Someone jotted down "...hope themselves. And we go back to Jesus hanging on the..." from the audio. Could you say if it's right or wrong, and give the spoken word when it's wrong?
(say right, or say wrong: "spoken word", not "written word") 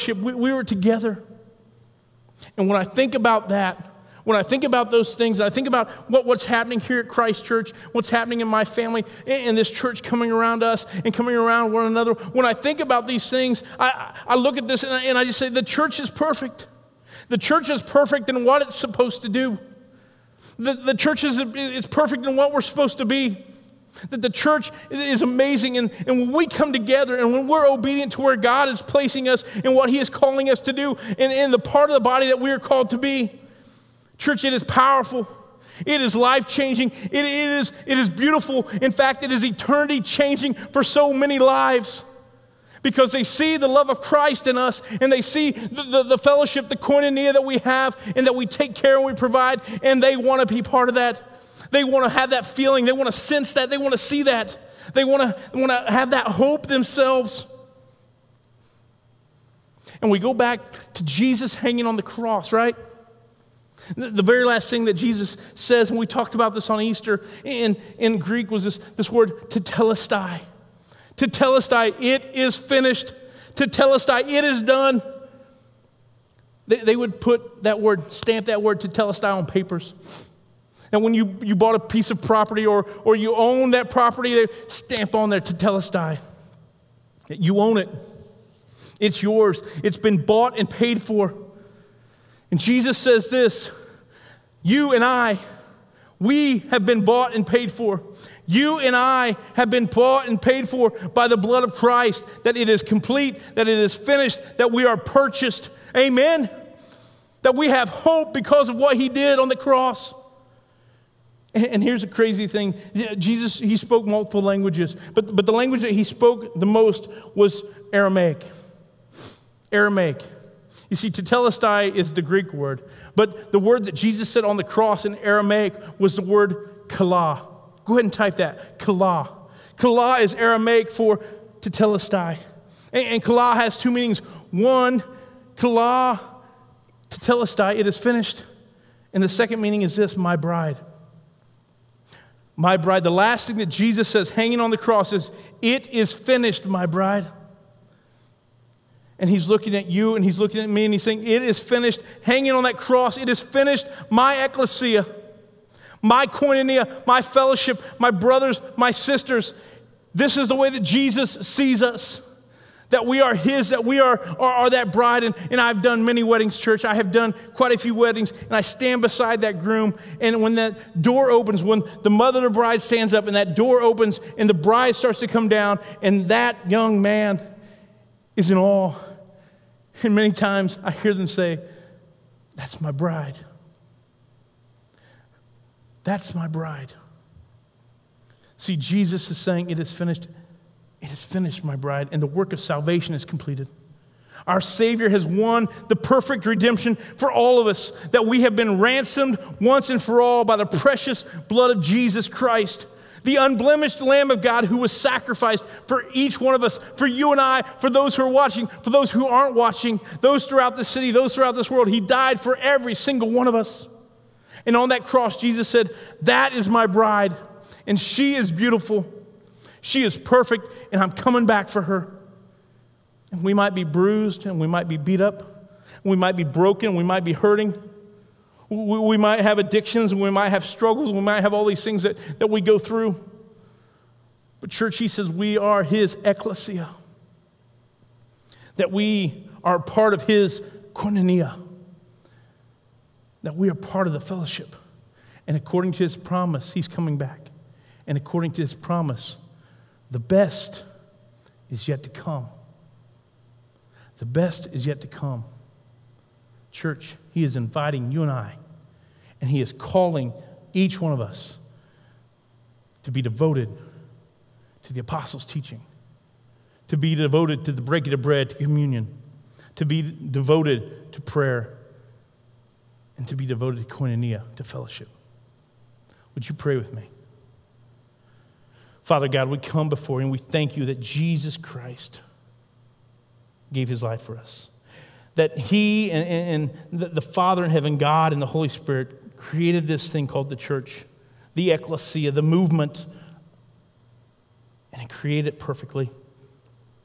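right.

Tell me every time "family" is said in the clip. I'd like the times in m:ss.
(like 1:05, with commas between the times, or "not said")
0:08.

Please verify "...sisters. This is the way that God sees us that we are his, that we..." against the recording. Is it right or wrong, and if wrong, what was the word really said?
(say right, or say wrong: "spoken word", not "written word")
wrong: "Jesus", not "God".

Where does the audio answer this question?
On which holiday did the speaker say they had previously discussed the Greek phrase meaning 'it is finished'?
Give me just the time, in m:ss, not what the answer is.
1:06.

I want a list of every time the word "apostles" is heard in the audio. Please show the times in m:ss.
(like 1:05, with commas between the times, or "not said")
4:25.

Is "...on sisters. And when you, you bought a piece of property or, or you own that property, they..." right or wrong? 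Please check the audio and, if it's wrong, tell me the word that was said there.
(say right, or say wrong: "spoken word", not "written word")
wrong: "papers", not "sisters".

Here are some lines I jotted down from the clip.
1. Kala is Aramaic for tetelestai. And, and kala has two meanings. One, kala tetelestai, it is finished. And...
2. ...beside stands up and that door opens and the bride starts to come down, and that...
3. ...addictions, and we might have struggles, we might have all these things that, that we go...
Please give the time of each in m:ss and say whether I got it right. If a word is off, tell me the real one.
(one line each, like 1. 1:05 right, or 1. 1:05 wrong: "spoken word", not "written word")
1. 2:09 right
2. 2:52 wrong: "bride", not "beside"
3. 3:49 right.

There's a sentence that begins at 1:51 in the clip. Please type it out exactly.
And here's a crazy thing Jesus, he spoke multiple languages, but, but the language that he spoke the most was Aramaic.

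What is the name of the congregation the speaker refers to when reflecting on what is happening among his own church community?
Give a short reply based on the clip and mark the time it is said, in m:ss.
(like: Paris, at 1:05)
Christ Church, at 0:07.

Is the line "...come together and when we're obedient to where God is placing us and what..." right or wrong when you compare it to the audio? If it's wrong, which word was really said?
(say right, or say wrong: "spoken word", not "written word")
right.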